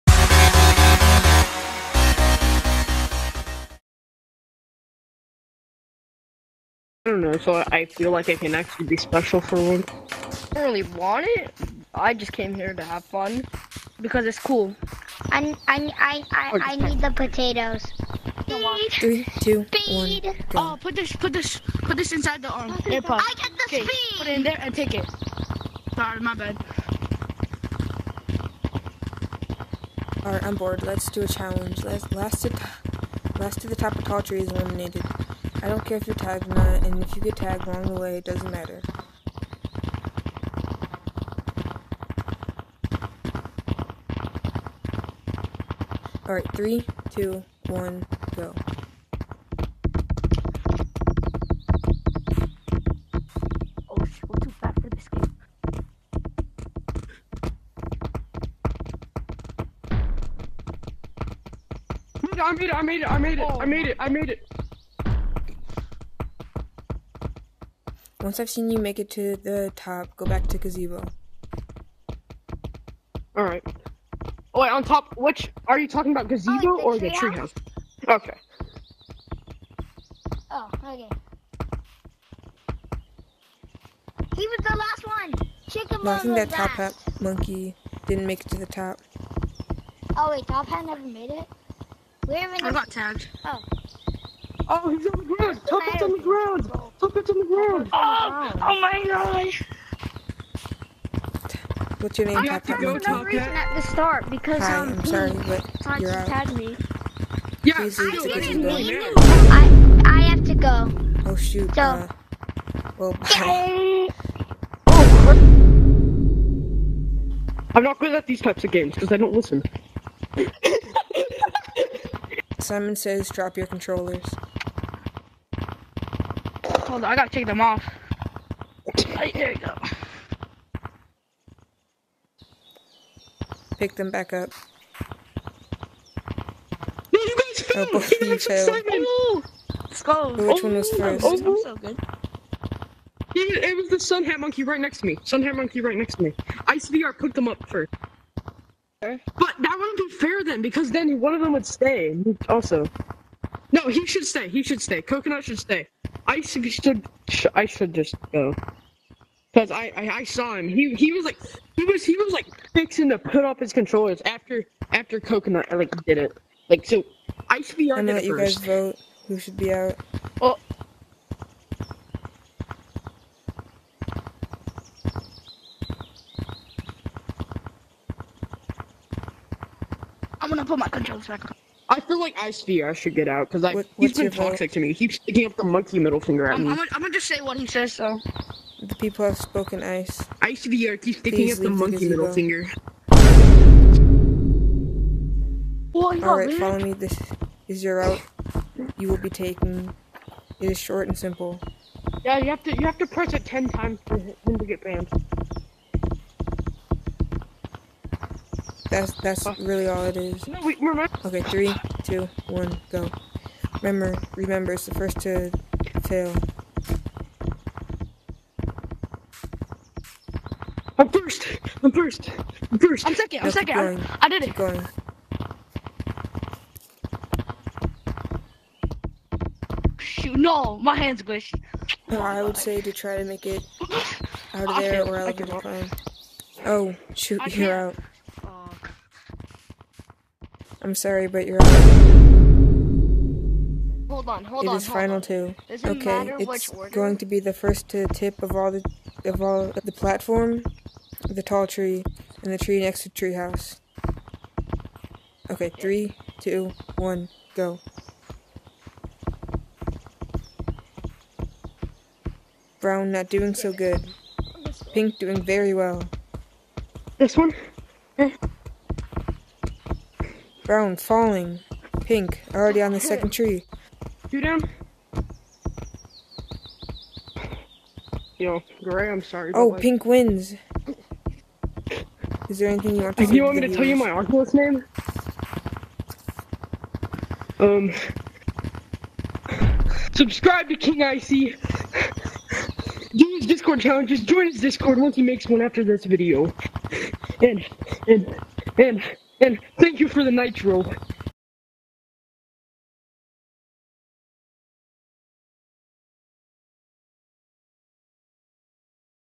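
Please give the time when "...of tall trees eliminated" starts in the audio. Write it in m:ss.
0:33.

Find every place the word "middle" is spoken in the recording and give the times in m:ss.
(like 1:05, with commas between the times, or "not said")
3:05, 3:12.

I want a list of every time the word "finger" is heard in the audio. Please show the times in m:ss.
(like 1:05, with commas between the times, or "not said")
3:06, 3:12.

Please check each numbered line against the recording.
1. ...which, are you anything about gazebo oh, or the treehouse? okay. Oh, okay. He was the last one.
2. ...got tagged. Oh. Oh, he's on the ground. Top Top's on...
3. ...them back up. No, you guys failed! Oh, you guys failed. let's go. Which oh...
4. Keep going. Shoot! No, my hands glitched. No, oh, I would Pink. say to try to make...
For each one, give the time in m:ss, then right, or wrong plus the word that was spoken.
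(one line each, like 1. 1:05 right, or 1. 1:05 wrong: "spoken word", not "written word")
1. 1:15 wrong: "talking", not "anything"
2. 1:32 wrong: "Hat", not "Top"
3. 2:13 right
4. 3:44 wrong: "God", not "Pink".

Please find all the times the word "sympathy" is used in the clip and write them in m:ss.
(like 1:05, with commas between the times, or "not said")
not said.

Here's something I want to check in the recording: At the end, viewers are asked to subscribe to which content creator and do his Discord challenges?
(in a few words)
King Icey.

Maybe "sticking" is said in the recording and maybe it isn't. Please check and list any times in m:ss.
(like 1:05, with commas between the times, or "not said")
3:05, 3:11.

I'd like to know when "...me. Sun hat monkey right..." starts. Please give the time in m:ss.
2:25.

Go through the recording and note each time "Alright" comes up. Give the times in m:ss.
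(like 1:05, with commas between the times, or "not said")
0:46, 1:13.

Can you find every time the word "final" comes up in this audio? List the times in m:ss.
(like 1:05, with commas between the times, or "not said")
4:04.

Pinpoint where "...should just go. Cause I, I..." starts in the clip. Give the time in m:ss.
2:37.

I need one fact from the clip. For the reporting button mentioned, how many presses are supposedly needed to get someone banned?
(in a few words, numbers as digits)
10.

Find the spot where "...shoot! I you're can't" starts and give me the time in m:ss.
3:57.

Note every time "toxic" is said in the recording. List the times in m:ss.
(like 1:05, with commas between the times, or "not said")
3:04.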